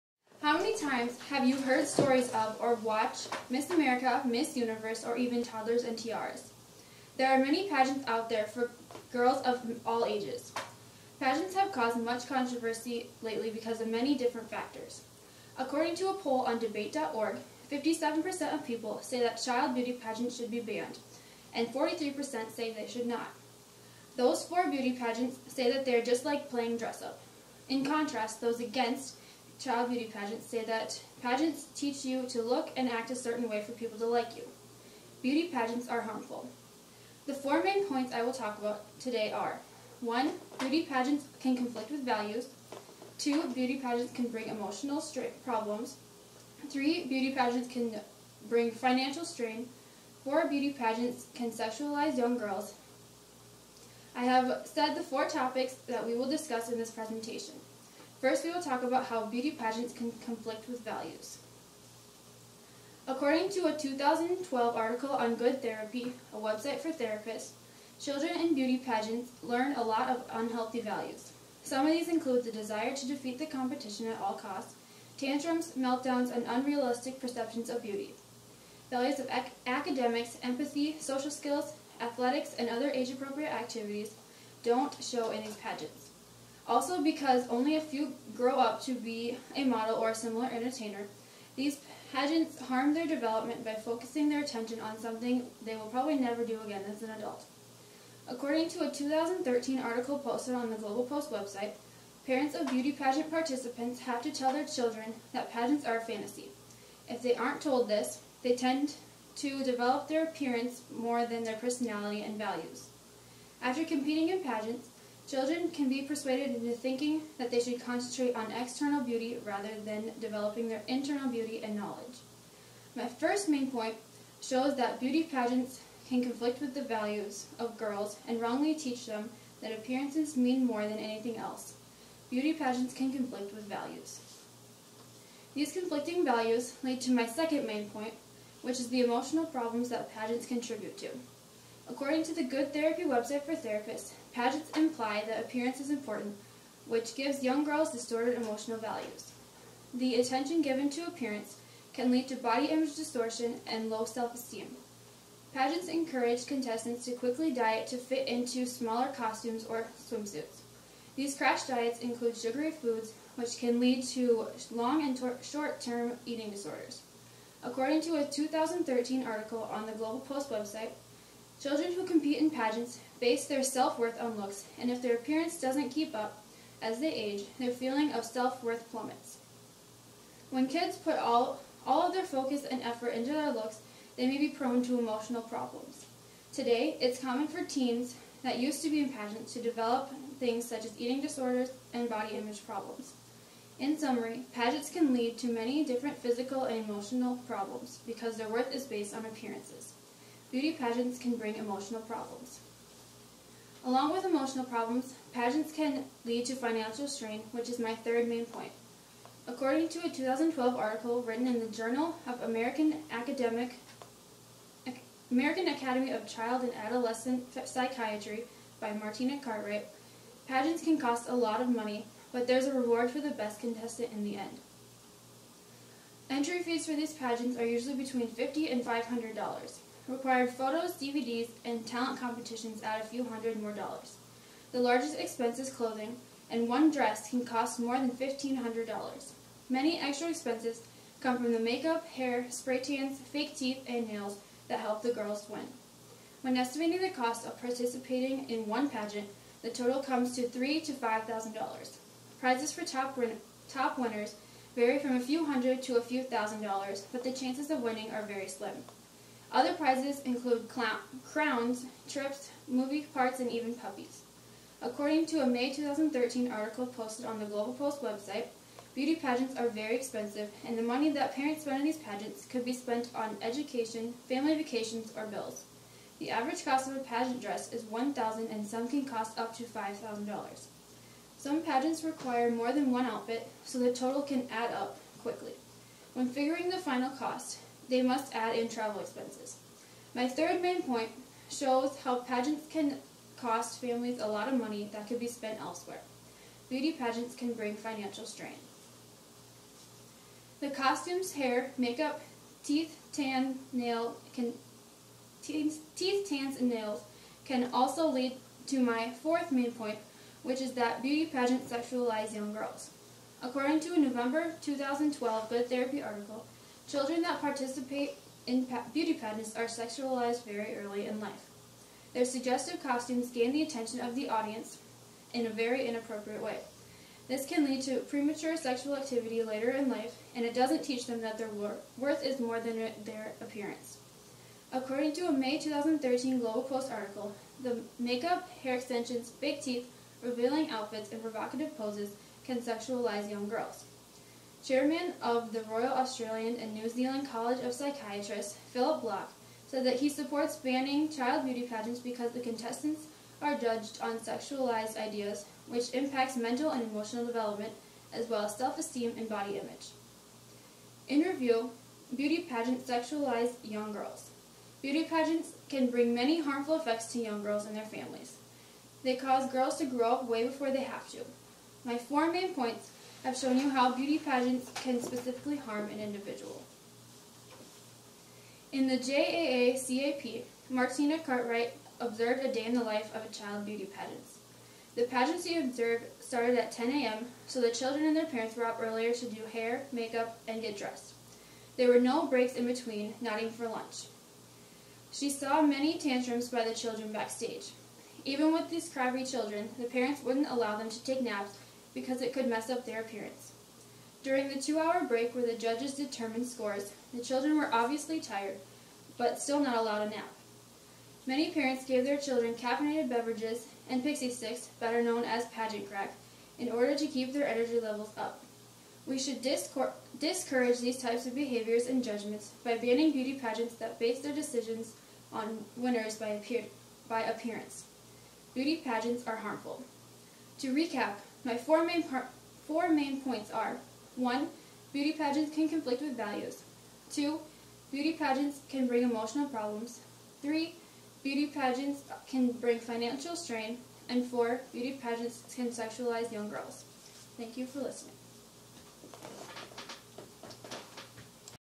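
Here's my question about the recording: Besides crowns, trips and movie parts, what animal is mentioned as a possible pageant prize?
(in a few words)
puppies.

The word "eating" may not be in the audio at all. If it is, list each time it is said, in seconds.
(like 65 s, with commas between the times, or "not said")
166 s, 190 s.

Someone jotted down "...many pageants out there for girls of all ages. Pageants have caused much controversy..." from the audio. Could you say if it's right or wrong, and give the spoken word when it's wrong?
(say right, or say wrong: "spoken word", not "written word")
right.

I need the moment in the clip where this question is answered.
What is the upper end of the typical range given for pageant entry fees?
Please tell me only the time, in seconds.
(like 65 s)
228 s.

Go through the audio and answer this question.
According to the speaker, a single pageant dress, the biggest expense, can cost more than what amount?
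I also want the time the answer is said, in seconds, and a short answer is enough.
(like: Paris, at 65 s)
$1,500, at 238 s.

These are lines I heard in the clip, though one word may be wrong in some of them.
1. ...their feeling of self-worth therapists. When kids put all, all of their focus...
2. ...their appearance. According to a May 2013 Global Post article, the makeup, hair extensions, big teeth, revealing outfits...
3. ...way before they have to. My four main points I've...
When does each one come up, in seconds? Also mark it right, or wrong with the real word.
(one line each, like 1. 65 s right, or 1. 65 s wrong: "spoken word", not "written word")
1. 177 s wrong: "plummets", not "therapists"
2. 333 s right
3. 370 s right.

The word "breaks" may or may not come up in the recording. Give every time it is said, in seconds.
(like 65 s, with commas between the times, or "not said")
392 s, 405 s.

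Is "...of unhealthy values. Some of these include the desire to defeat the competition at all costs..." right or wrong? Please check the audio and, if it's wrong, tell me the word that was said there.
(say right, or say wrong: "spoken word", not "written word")
right.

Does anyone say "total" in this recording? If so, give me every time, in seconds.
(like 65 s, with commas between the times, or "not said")
249 s, 283 s.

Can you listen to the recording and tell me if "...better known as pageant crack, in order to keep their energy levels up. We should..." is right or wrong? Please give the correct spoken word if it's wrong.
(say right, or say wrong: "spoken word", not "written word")
right.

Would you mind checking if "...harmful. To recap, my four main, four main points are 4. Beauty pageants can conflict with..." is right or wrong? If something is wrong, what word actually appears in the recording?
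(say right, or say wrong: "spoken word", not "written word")
wrong: "1", not "4".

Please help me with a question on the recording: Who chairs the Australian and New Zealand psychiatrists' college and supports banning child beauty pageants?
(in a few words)
Philip Block.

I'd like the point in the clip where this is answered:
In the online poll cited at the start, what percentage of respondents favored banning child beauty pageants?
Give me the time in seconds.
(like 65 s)
17 s.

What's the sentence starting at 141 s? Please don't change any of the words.
According to the Good Therapy website for therapists, pageants imply that appearance is important, which gives young girls distorted emotional values.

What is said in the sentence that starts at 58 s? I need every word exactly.
First, we will talk about how beauty pageants can conflict with values.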